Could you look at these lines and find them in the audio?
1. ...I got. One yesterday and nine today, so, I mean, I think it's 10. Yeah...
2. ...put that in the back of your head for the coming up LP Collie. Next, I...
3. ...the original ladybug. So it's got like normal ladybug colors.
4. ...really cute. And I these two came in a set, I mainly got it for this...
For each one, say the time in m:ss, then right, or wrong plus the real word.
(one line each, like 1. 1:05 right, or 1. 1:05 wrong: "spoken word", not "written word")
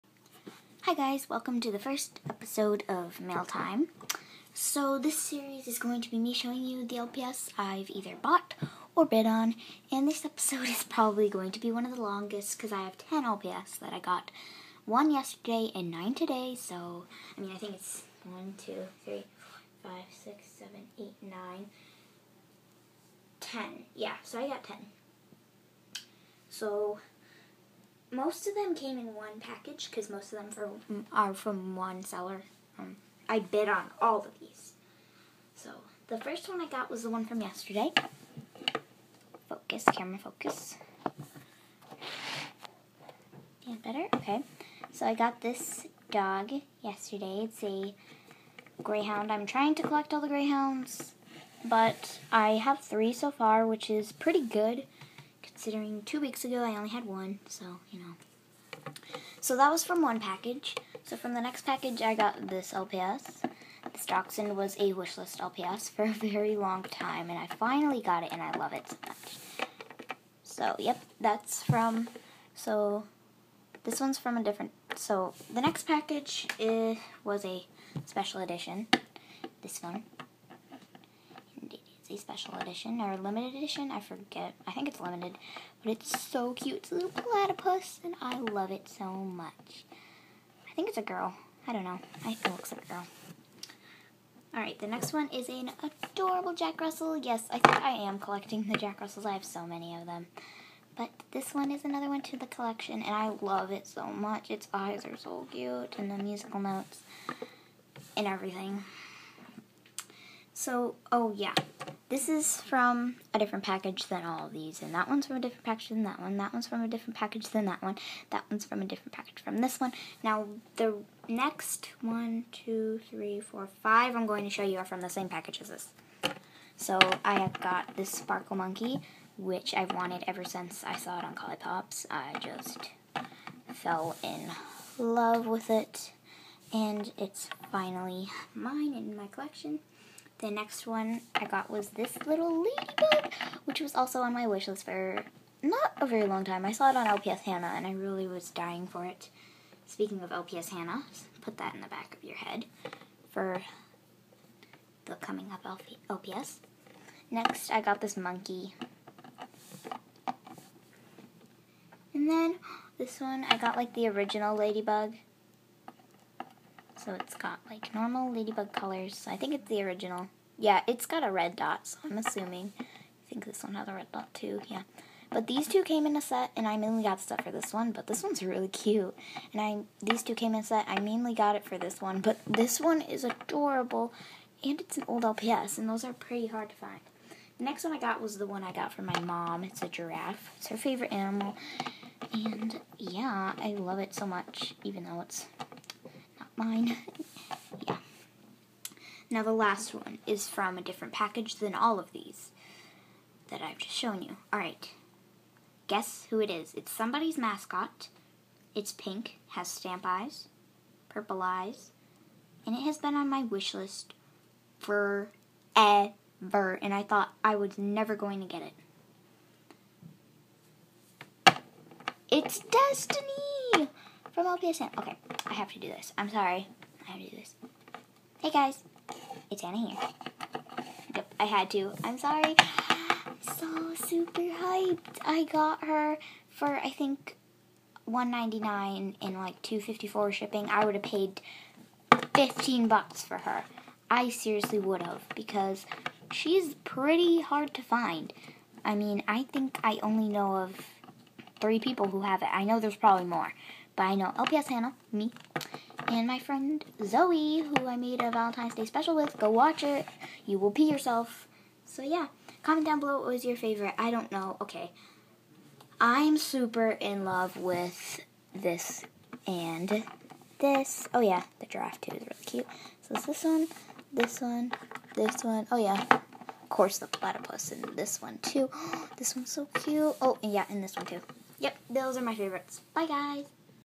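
1. 0:13 right
2. 2:31 wrong: "LPS", not "Collie"
3. 2:43 right
4. 2:58 right.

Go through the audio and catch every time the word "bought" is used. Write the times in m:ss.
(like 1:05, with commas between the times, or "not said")
0:08.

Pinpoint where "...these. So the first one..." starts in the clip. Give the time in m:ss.
0:34.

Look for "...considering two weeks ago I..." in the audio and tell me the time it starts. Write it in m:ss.
0:55.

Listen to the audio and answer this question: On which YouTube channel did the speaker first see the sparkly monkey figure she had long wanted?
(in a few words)
Collie Pops.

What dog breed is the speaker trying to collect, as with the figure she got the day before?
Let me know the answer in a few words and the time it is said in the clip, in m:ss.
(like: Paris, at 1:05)
Greyhound, at 0:48.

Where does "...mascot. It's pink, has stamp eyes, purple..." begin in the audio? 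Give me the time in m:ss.
3:27.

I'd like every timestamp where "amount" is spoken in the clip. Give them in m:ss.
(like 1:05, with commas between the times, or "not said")
not said.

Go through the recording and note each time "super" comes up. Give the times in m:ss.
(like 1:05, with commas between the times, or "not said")
3:53, 4:26.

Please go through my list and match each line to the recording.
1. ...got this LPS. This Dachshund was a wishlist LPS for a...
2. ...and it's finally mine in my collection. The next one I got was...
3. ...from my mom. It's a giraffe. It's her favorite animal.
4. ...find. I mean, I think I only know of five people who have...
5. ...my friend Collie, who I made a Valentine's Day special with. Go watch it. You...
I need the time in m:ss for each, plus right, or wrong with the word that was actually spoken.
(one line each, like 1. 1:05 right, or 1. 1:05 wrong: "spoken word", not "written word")
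1. 1:02 right
2. 2:16 right
3. 3:08 right
4. 4:07 wrong: "three", not "five"
5. 4:16 wrong: "Zoe", not "Collie".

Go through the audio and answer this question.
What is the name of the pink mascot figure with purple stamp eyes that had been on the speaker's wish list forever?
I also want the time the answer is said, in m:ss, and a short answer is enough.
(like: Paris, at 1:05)
Destiny, at 3:42.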